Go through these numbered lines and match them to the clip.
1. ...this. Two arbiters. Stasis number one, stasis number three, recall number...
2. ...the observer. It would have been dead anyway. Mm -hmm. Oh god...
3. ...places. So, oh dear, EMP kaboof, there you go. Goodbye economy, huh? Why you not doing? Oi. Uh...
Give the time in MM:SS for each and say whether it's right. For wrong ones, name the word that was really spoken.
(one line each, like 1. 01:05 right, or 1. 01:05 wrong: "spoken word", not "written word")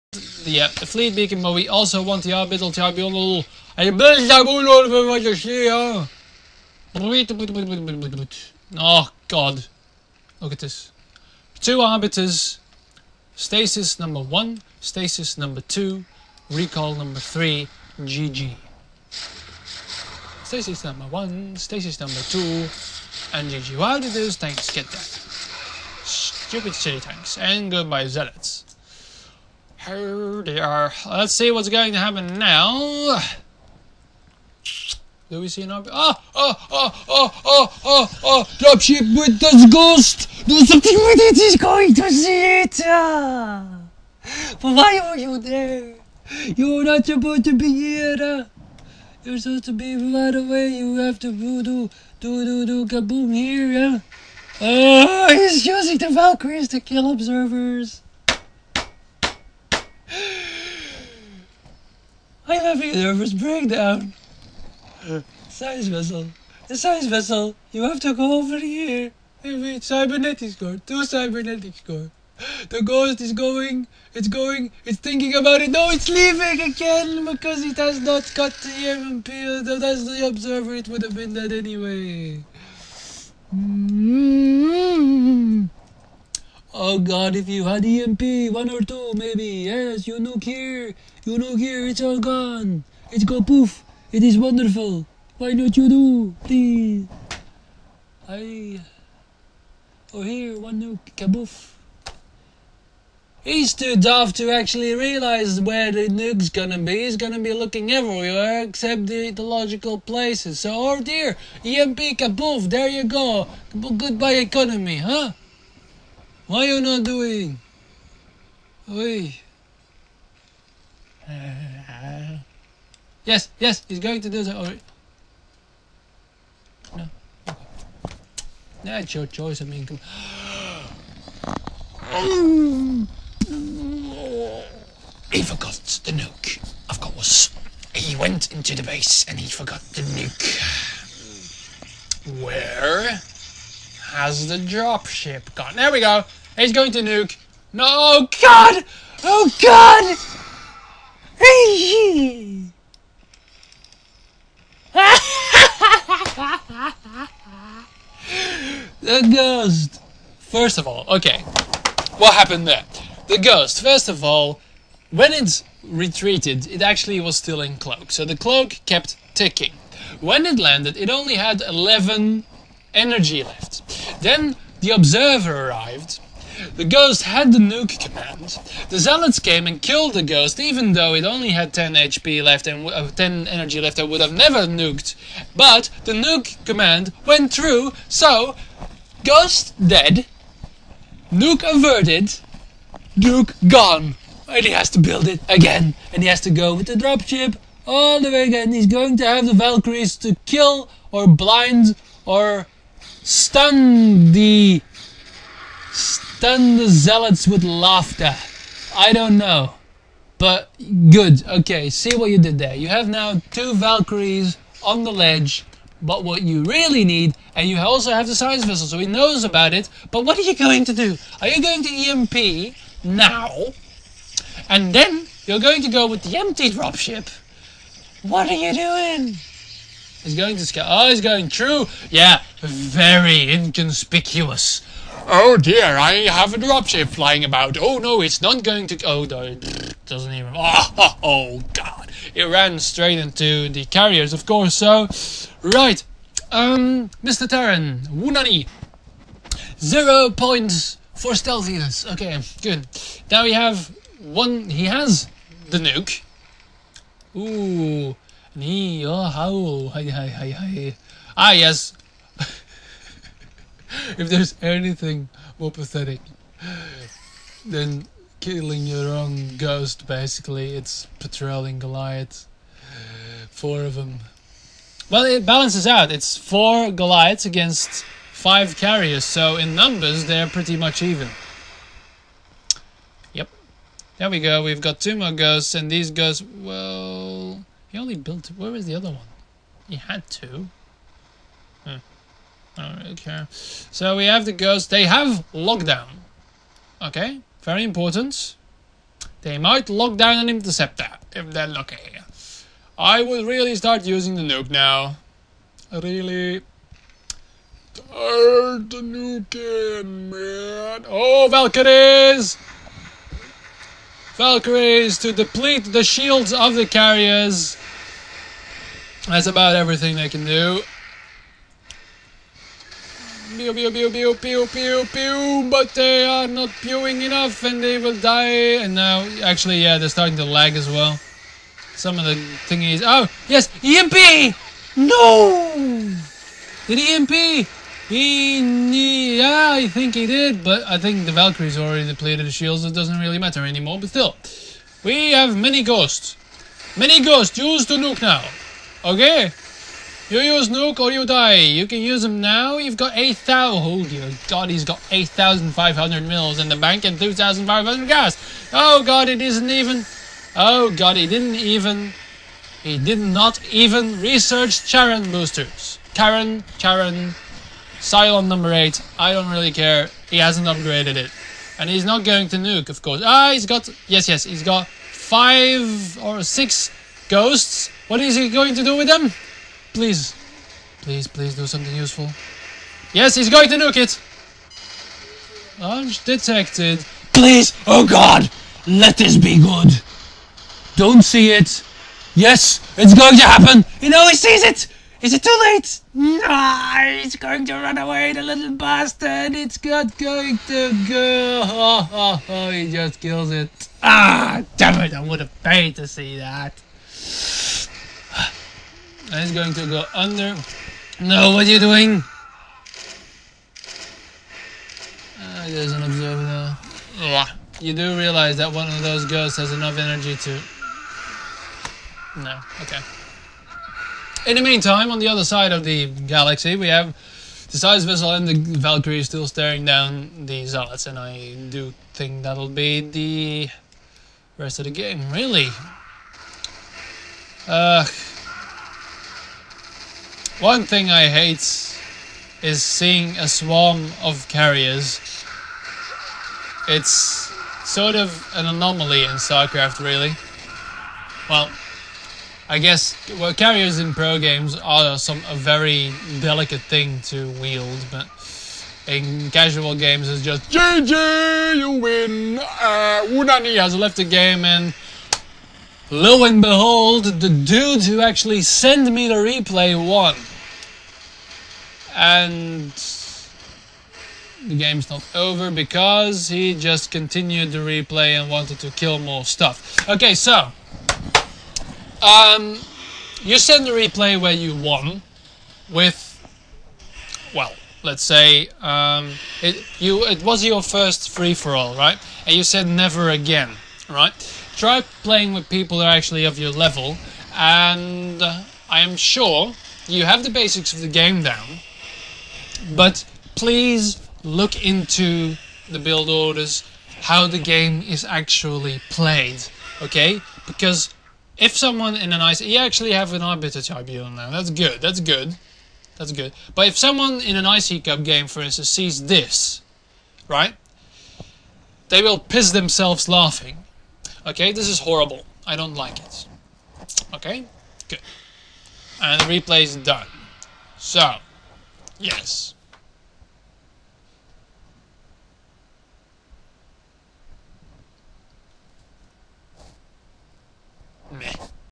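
1. 00:10 wrong: "two", not "three"
2. 01:20 right
3. 01:49 right.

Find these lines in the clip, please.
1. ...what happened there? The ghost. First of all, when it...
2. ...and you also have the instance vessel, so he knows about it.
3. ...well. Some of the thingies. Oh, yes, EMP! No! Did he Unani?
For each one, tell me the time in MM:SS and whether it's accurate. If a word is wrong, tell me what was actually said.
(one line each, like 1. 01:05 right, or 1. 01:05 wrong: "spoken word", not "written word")
1. 02:42 right
2. 03:37 wrong: "science", not "instance"
3. 05:30 wrong: "EMP", not "Unani".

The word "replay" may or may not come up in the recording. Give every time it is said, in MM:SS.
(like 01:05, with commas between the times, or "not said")
07:49, 07:57, 08:03, 08:49.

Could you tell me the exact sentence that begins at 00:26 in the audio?
Stupid siege tanks, and goodbye zealots.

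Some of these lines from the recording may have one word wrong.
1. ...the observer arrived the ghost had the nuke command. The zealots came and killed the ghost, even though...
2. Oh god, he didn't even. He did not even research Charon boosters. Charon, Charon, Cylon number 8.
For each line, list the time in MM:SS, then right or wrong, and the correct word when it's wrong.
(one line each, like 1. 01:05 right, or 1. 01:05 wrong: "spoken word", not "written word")
1. 02:54 right
2. 06:00 right.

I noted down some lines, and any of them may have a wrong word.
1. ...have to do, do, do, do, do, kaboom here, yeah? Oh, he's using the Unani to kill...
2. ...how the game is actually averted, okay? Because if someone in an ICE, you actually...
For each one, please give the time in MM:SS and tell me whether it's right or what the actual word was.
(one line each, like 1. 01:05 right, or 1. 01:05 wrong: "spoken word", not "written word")
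1. 00:50 wrong: "Valkyries", not "Unani"
2. 08:27 wrong: "played", not "averted".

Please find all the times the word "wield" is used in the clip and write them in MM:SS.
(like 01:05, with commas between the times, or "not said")
07:37.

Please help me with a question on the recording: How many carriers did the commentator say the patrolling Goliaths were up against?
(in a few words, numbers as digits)
5.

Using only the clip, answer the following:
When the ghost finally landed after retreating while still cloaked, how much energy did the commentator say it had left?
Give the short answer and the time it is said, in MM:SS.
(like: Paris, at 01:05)
11, at 02:51.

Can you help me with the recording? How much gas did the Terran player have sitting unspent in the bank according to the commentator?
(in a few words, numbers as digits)
2,500.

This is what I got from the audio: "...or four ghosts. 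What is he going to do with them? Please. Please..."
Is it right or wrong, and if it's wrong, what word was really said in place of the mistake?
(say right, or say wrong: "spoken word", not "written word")
wrong: "six", not "four".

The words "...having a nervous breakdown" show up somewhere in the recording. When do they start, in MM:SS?
01:02.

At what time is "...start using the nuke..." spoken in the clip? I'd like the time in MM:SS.
05:03.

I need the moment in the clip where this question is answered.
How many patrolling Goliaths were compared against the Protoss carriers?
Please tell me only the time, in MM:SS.
04:33.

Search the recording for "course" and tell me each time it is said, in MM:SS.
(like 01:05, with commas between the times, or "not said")
02:16, 04:04, 06:13.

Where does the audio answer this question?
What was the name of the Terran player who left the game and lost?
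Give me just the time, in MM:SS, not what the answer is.
07:43.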